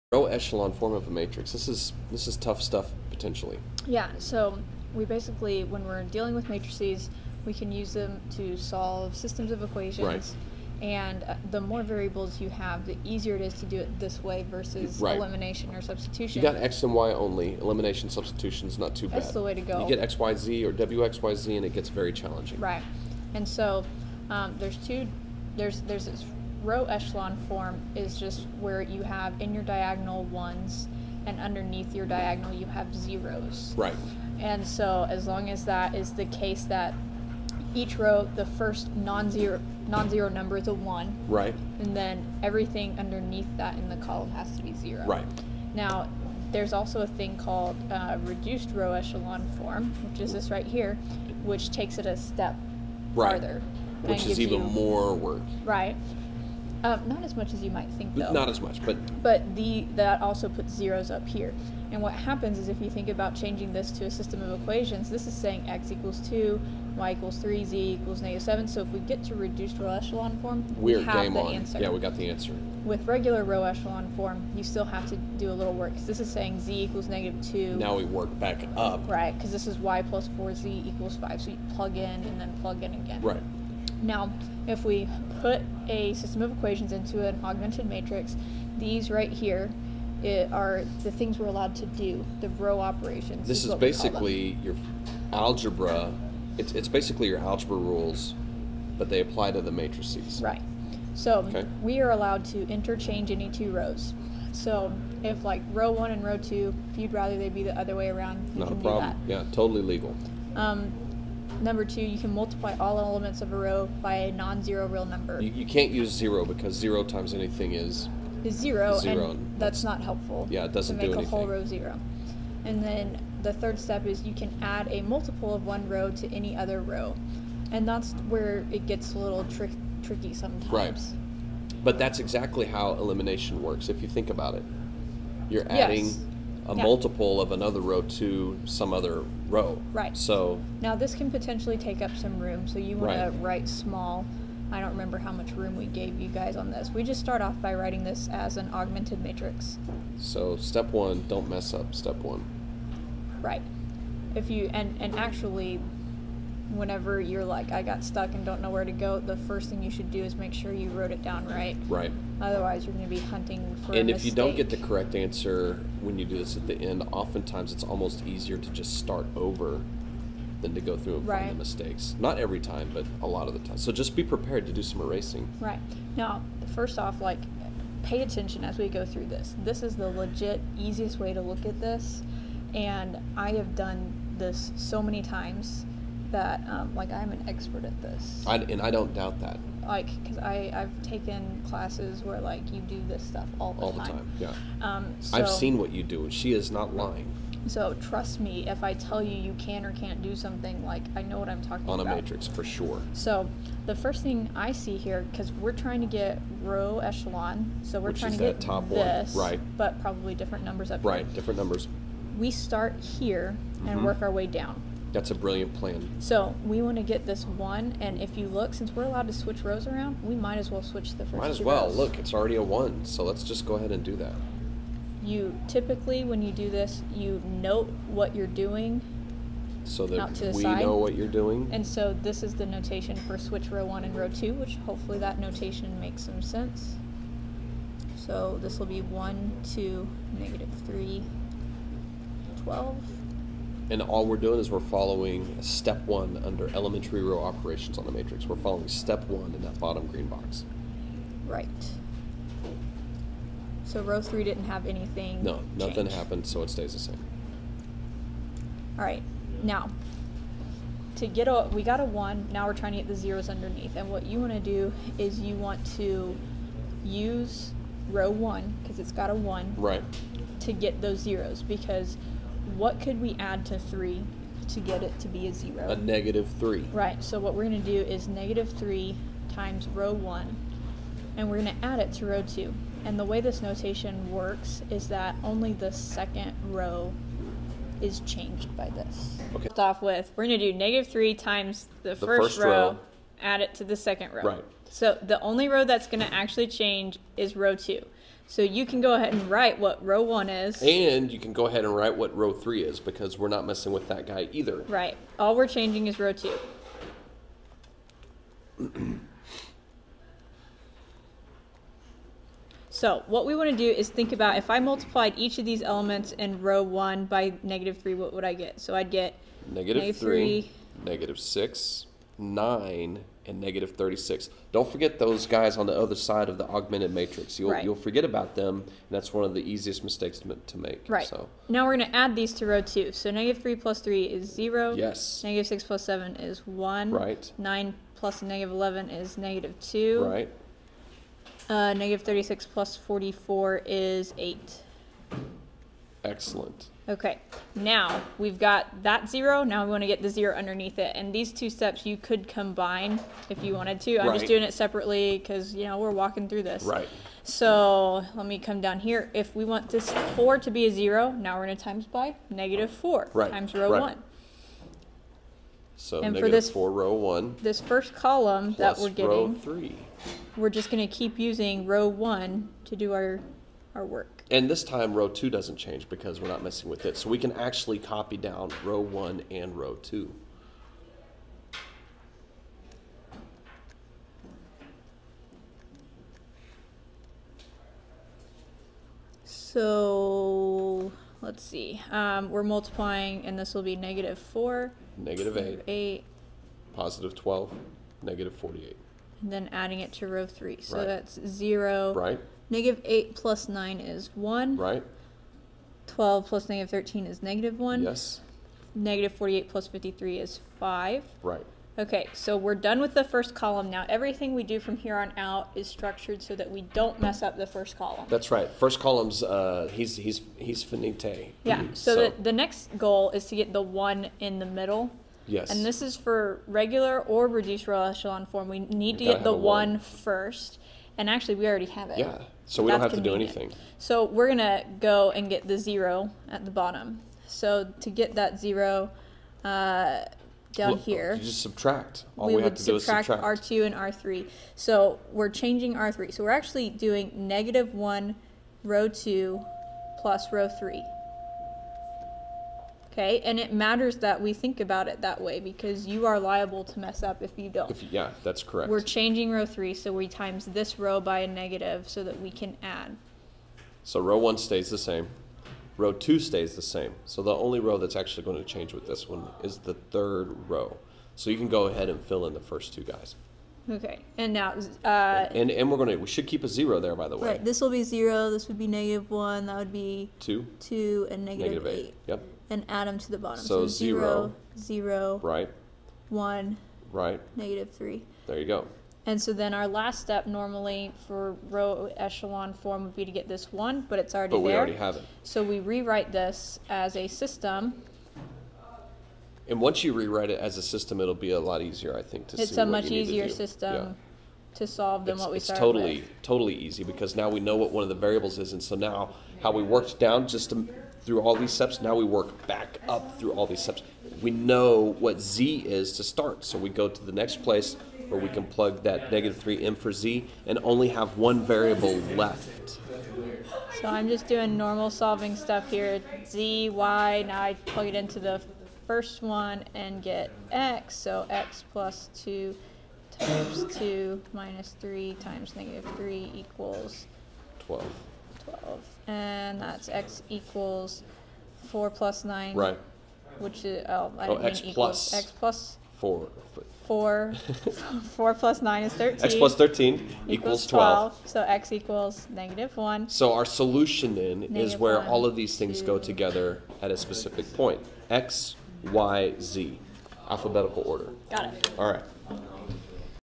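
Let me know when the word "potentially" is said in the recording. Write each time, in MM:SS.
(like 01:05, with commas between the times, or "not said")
00:03, 02:21.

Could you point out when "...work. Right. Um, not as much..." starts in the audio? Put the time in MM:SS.
00:55.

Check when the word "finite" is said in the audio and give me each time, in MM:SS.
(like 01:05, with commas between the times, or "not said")
07:00.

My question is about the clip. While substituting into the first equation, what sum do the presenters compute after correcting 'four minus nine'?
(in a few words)
13.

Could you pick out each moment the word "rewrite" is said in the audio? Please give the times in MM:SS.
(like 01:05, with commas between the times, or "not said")
08:15, 08:20.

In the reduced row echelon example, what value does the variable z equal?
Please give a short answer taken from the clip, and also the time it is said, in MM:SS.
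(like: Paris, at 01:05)
-7, at 01:07.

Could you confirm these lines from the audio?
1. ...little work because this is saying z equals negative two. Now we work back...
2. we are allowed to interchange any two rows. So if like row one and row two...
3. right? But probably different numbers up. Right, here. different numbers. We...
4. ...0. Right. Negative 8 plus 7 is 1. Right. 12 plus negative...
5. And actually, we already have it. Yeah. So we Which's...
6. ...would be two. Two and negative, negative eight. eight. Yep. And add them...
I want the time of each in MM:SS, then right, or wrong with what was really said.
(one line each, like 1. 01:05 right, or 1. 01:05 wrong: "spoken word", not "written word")
1. 01:15 right
2. 01:41 right
3. 03:29 right
4. 06:41 wrong: "9", not "7"
5. 07:11 wrong: "That", not "Which"
6. 07:59 right.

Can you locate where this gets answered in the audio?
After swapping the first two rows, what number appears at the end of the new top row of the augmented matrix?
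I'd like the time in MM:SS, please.
04:02.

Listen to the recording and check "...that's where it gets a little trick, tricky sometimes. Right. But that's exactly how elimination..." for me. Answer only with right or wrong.
right.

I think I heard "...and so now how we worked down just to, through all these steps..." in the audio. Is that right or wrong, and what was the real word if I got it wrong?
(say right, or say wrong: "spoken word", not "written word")
right.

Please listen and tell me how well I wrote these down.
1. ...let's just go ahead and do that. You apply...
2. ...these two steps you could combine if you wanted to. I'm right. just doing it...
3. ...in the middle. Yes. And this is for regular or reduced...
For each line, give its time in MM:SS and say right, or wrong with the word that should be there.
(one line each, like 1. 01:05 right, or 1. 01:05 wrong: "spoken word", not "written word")
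1. 03:43 wrong: "typically", not "apply"
2. 05:51 right
3. 07:04 right.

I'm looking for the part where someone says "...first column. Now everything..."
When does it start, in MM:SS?
06:53.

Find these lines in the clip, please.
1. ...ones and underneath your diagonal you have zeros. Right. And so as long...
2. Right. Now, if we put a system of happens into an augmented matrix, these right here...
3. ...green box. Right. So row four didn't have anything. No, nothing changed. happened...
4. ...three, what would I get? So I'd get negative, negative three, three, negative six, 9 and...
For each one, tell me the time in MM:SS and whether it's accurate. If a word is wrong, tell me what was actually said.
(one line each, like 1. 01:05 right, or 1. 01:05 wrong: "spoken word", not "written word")
1. 00:30 right
2. 01:23 wrong: "equations", not "happens"
3. 04:10 wrong: "three", not "four"
4. 05:17 right.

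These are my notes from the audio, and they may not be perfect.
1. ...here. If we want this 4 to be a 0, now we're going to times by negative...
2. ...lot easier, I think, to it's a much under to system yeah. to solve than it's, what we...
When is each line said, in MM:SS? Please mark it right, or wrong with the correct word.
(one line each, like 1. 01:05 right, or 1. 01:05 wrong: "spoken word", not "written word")
1. 05:58 right
2. 08:21 wrong: "easier", not "under".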